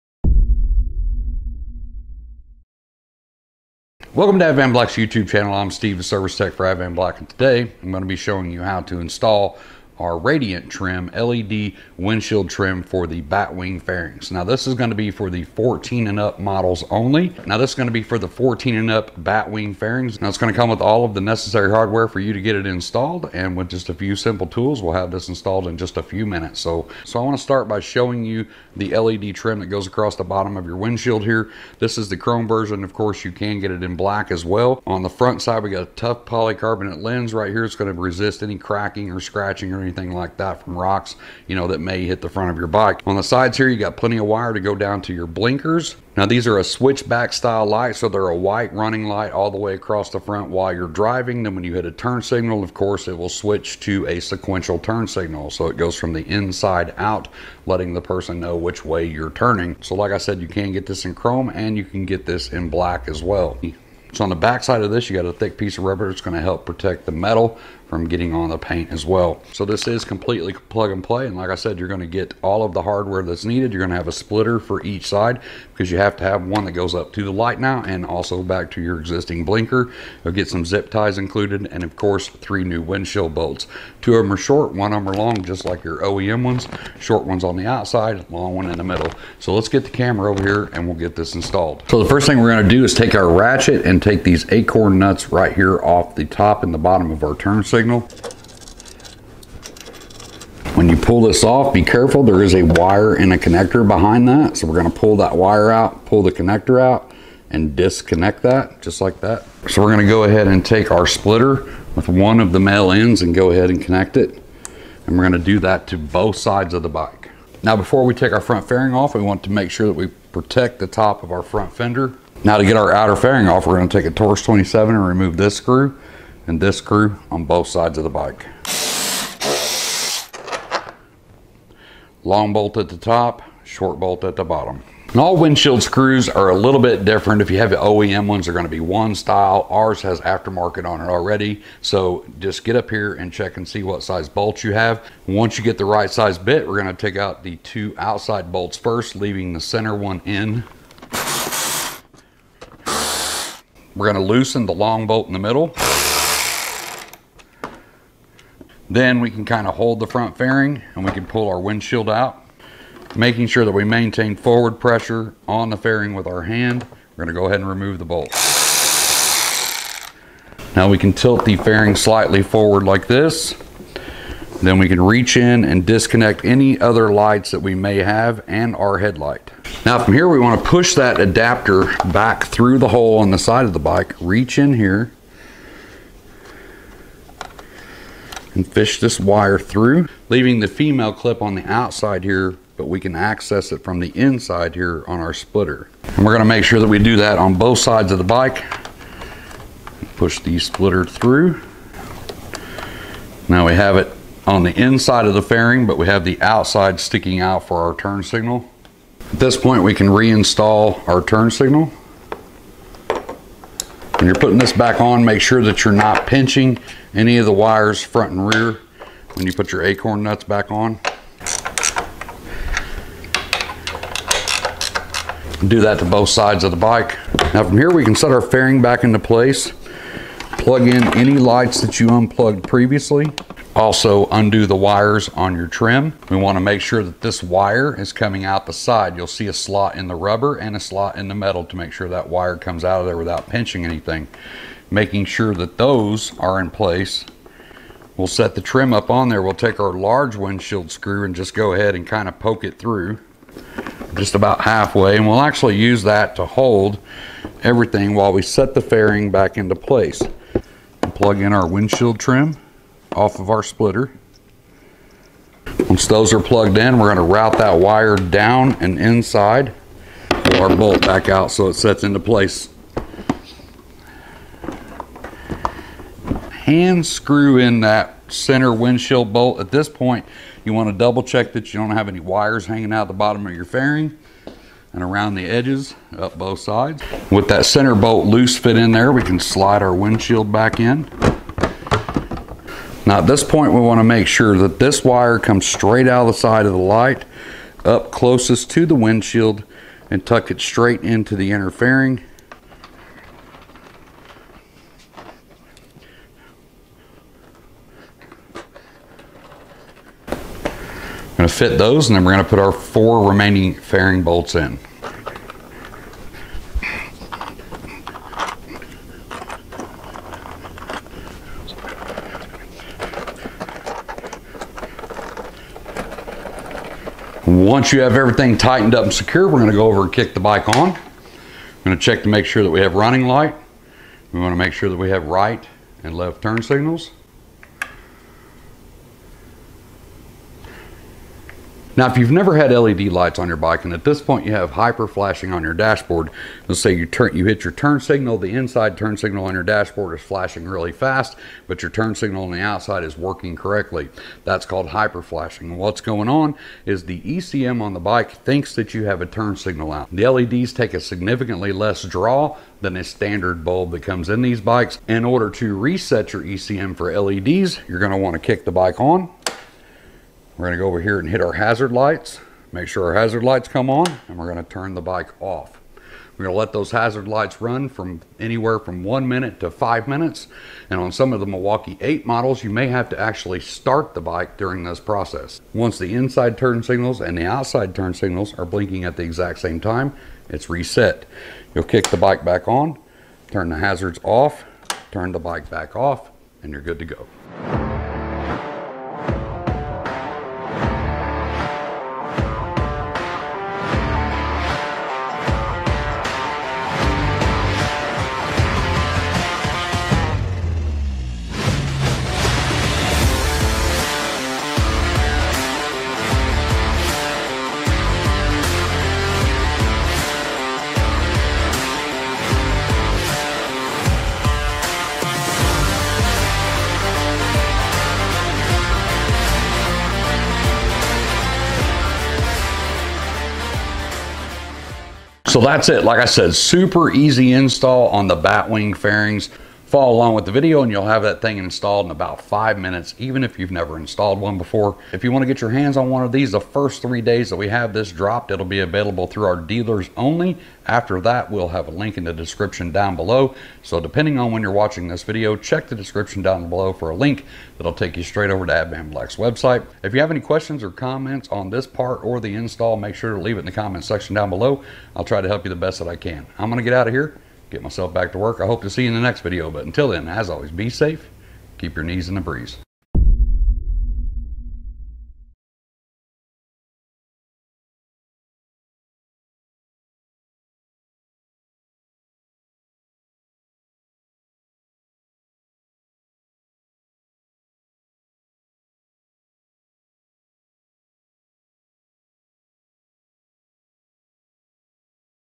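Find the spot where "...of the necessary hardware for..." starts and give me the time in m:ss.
0:21.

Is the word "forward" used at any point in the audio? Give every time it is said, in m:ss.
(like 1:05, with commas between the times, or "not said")
2:44, 2:52.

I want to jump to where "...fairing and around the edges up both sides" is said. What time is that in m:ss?
4:43.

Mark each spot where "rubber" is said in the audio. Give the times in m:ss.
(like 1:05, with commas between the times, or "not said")
1:05, 4:00.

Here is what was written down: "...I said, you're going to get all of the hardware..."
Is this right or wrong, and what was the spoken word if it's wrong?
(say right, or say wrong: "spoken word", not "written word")
right.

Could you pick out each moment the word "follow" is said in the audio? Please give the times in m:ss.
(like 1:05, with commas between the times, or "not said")
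7:19.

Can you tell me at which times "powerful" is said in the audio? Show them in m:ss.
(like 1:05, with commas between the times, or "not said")
not said.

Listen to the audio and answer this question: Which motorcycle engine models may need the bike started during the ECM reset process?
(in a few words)
Milwaukee 8.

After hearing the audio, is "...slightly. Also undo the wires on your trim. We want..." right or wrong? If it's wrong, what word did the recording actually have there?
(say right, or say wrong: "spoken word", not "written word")
wrong: "previously", not "slightly".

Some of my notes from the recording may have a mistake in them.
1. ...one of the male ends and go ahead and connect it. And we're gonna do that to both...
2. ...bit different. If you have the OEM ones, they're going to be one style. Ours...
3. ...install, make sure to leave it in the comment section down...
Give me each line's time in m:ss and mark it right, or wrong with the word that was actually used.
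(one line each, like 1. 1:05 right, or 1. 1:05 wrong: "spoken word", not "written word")
1. 1:52 right
2. 2:16 right
3. 7:42 right.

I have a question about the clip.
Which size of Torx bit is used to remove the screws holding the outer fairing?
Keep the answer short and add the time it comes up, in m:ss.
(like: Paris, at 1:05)
Torx 27, at 2:04.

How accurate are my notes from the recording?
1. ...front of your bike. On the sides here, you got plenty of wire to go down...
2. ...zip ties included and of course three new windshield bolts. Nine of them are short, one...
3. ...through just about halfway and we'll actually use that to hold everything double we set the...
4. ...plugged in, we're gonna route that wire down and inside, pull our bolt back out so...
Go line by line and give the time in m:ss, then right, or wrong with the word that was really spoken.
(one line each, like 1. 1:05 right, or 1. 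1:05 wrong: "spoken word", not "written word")
1. 0:42 right
2. 1:20 wrong: "Two", not "Nine"
3. 4:12 wrong: "while", not "double"
4. 4:26 right.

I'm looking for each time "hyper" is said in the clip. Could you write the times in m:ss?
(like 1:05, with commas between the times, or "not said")
5:44, 5:54.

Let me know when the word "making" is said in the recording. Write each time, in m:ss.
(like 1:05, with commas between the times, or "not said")
2:43, 4:04.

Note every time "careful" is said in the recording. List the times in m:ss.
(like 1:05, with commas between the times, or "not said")
1:41.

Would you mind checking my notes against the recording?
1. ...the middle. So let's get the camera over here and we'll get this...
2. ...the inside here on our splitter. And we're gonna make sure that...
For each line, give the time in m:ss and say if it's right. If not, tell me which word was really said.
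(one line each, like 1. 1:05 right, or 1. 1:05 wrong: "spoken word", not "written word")
1. 1:28 right
2. 3:13 right.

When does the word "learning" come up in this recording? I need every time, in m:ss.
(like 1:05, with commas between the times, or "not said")
not said.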